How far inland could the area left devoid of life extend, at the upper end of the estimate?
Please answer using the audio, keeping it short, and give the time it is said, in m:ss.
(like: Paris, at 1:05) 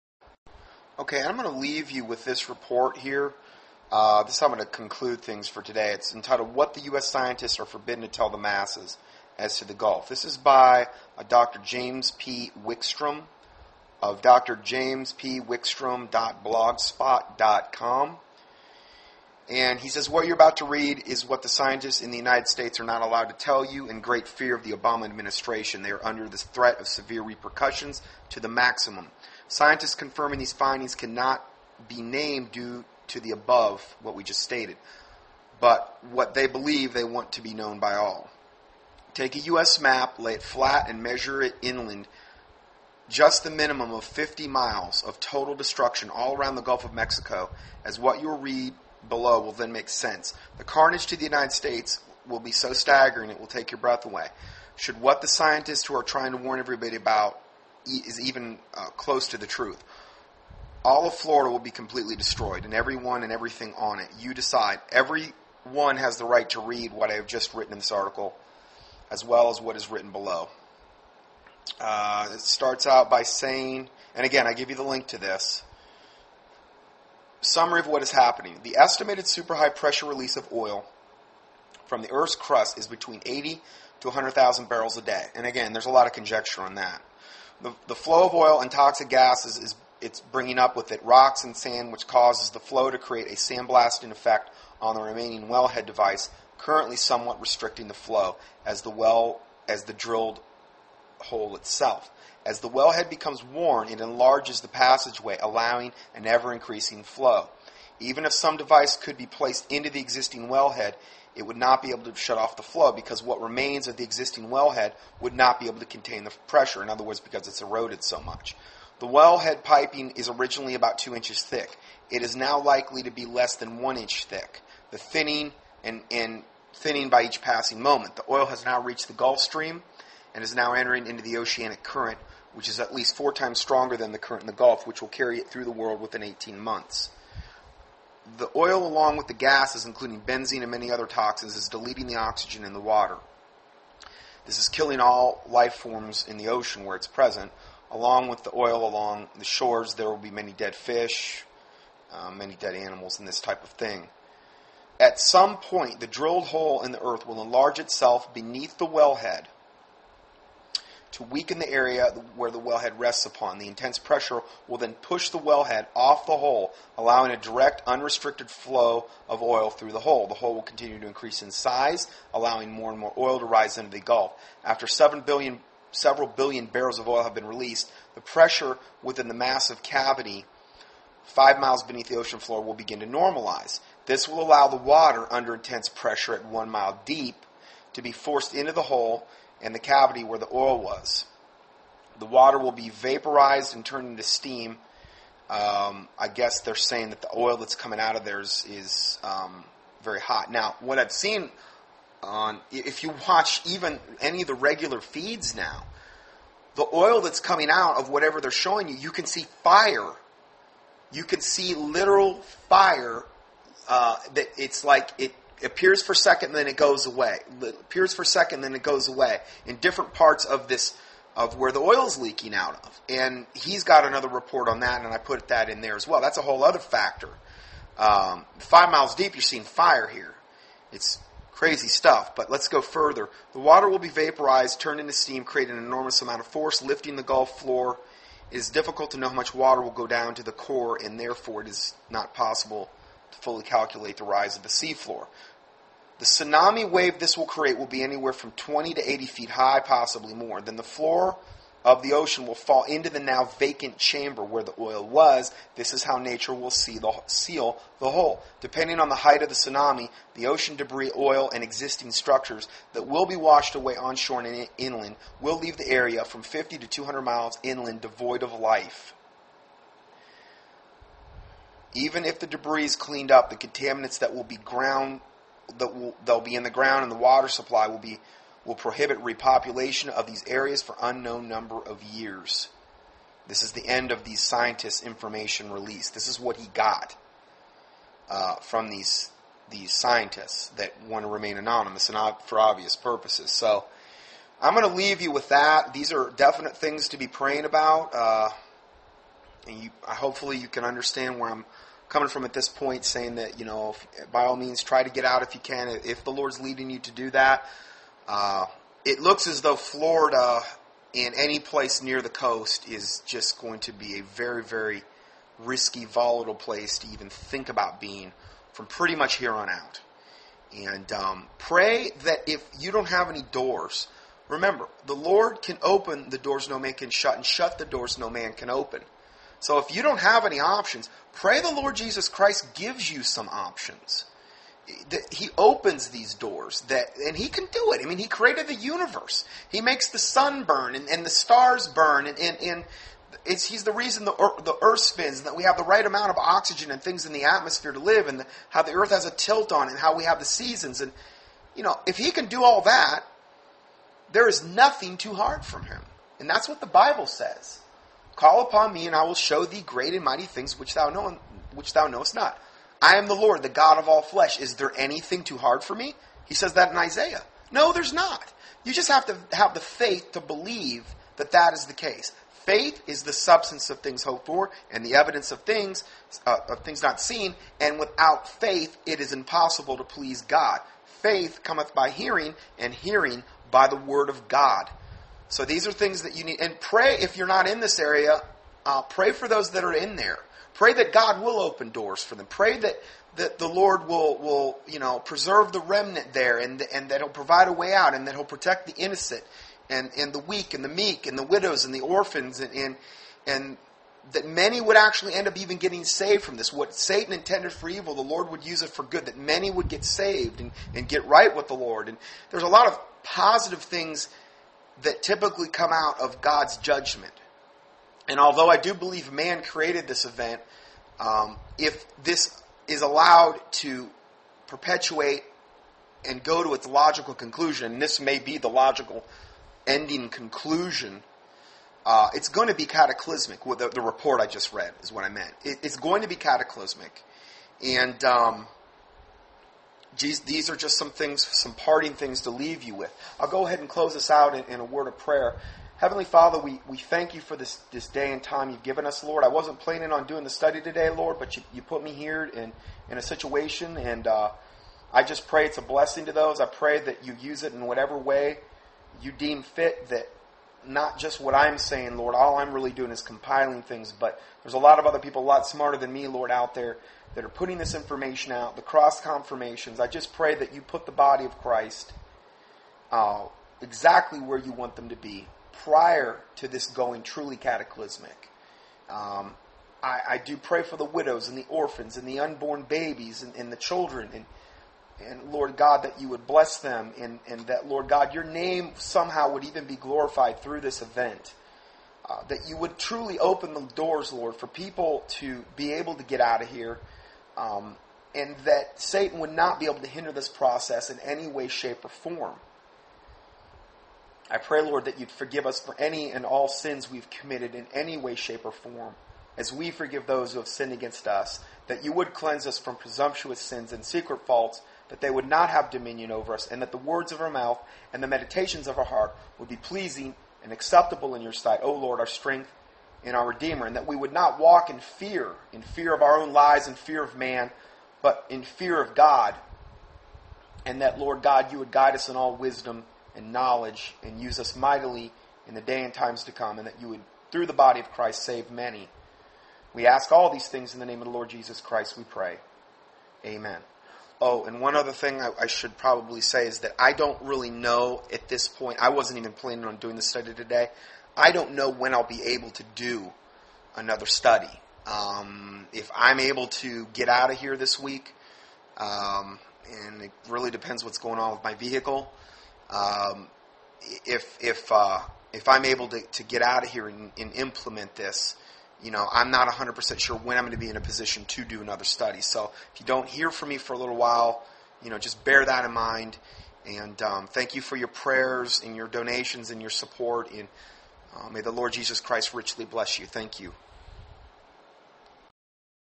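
200 miles, at 4:26.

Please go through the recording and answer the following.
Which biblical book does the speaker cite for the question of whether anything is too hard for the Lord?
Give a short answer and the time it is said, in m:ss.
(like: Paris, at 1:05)
Isaiah, at 6:06.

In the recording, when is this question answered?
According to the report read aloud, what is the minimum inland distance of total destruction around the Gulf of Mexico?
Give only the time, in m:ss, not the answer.
0:44.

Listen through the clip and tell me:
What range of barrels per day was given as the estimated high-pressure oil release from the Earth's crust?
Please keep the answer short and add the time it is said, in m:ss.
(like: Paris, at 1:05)
80 to 100,000, at 1:23.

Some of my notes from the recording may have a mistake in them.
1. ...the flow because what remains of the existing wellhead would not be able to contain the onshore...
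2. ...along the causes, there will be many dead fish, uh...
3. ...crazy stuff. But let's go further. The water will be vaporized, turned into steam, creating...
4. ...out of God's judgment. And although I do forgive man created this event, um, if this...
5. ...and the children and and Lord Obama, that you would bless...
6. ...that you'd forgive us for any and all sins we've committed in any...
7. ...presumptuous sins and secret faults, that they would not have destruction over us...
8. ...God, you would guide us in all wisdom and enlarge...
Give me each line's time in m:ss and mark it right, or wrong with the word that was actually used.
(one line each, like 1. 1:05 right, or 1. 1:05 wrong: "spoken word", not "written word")
1. 1:52 wrong: "pressure", not "onshore"
2. 2:28 wrong: "shores", not "causes"
3. 3:51 right
4. 6:55 wrong: "believe", not "forgive"
5. 8:03 wrong: "God", not "Obama"
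6. 8:25 right
7. 8:32 wrong: "dominion", not "destruction"
8. 8:51 wrong: "knowledge", not "enlarge".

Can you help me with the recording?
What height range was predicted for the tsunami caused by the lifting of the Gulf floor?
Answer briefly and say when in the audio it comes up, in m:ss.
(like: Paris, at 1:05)
20 to 80 feet, at 4:08.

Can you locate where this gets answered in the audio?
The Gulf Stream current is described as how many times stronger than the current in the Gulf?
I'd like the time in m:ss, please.
2:13.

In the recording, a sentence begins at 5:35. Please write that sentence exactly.
He opens these doors that, and he can do it.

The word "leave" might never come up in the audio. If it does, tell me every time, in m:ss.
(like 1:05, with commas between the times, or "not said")
0:01, 4:25, 4:54, 7:22.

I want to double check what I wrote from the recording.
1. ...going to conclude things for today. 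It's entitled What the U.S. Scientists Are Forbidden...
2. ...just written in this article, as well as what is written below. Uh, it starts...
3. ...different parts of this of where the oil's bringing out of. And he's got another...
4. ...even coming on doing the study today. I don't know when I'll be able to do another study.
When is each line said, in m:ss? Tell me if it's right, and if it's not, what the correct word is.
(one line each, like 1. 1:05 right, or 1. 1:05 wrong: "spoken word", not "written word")
1. 0:04 right
2. 1:07 right
3. 3:39 wrong: "leaking", not "bringing"
4. 9:09 wrong: "planning", not "coming".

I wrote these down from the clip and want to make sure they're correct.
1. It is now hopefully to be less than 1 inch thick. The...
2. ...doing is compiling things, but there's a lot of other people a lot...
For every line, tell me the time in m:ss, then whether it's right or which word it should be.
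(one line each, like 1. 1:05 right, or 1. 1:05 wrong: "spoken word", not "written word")
1. 2:02 wrong: "likely", not "hopefully"
2. 7:42 right.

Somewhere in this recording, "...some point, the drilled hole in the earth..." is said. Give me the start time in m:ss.
2:35.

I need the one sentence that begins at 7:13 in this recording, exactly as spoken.
Well, the, the, report I just read is what I meant.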